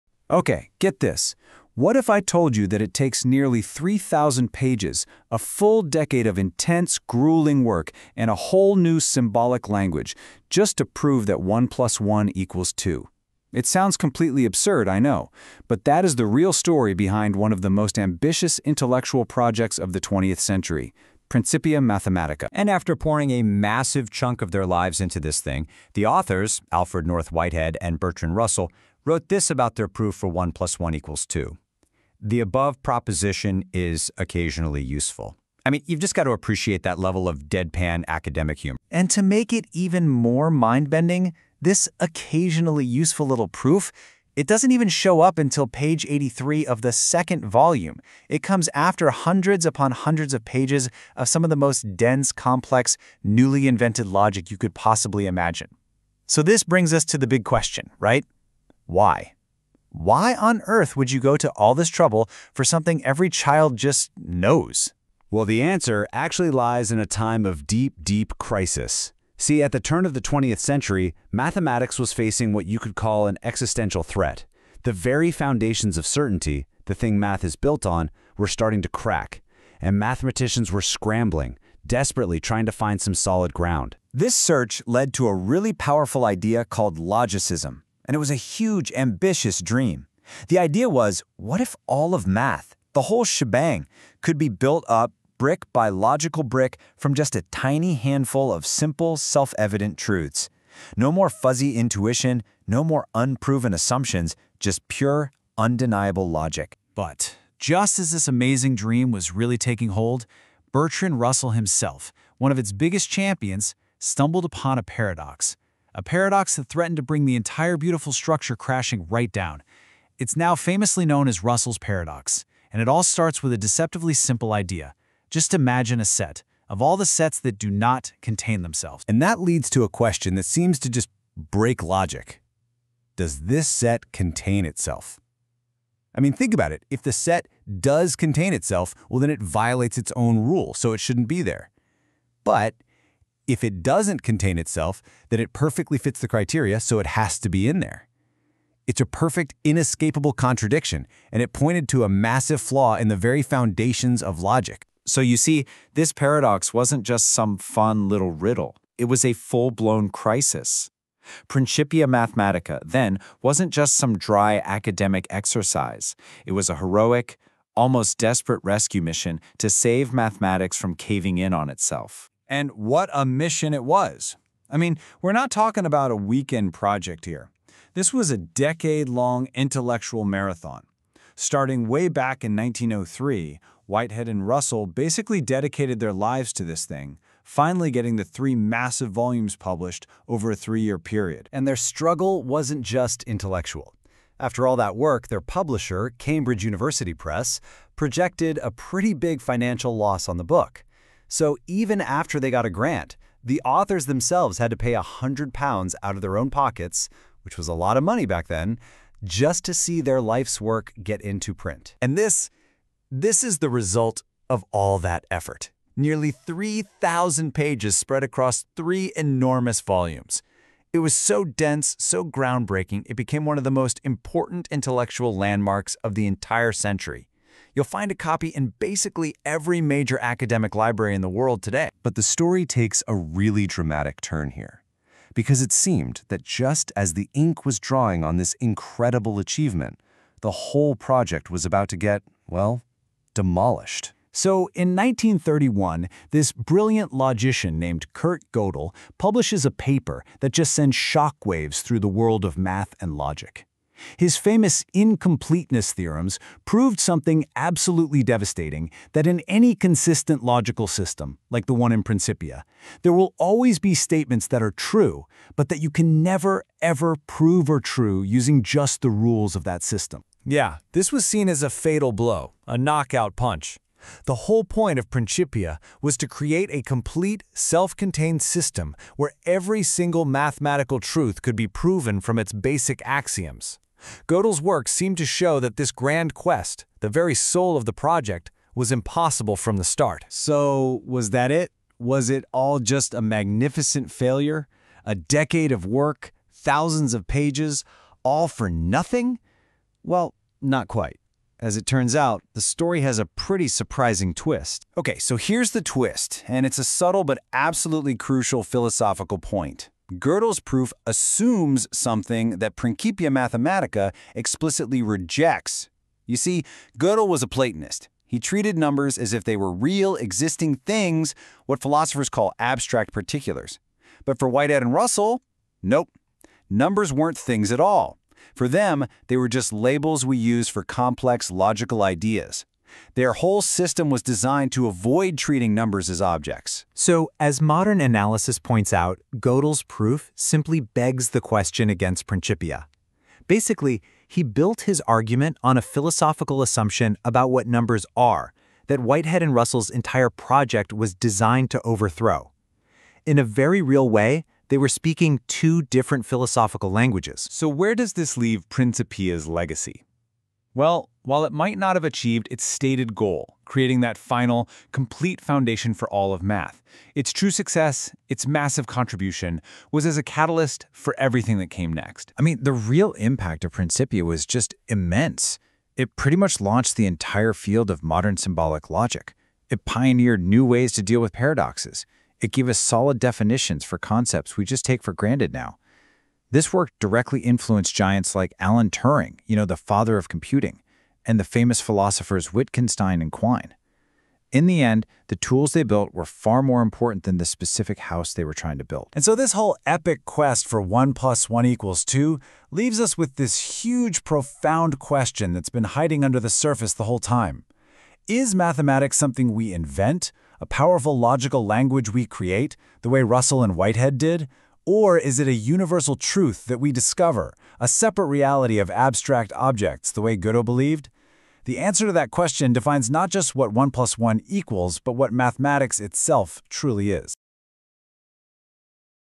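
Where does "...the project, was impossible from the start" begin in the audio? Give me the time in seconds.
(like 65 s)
287 s.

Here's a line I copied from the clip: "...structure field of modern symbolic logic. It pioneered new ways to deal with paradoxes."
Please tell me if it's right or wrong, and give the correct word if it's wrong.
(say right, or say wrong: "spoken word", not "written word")
wrong: "entire", not "structure".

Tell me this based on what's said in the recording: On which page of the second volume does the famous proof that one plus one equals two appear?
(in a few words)
83.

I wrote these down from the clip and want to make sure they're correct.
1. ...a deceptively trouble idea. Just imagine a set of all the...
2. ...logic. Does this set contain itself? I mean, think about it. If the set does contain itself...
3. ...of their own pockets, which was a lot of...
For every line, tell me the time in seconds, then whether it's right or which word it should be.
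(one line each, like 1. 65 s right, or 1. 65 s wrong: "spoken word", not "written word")
1. 123 s wrong: "simple", not "trouble"
2. 131 s right
3. 206 s right.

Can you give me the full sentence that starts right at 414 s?
Or is it a universal truth that we discover, a separate reality of abstract objects, the way Gödel believed?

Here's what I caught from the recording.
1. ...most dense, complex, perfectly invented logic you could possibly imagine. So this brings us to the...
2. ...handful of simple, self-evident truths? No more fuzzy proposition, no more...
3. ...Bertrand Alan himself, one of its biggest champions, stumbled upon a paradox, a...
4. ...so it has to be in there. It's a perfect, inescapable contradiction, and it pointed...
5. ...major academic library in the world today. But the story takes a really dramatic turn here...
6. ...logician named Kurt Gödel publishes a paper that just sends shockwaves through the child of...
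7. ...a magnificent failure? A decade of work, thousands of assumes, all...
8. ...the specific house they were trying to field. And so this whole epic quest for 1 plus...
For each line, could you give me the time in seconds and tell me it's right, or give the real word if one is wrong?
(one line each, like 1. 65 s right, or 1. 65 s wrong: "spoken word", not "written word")
1. 51 s wrong: "newly", not "perfectly"
2. 97 s wrong: "intuition", not "proposition"
3. 110 s wrong: "Russell", not "Alan"
4. 146 s right
5. 229 s right
6. 247 s wrong: "world", not "child"
7. 293 s wrong: "pages", not "assumes"
8. 397 s wrong: "build", not "field".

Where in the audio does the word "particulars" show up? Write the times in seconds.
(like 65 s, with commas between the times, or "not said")
323 s.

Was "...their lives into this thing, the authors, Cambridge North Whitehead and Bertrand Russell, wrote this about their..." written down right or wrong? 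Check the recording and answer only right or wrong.
wrong.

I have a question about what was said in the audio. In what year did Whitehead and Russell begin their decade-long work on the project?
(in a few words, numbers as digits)
1903.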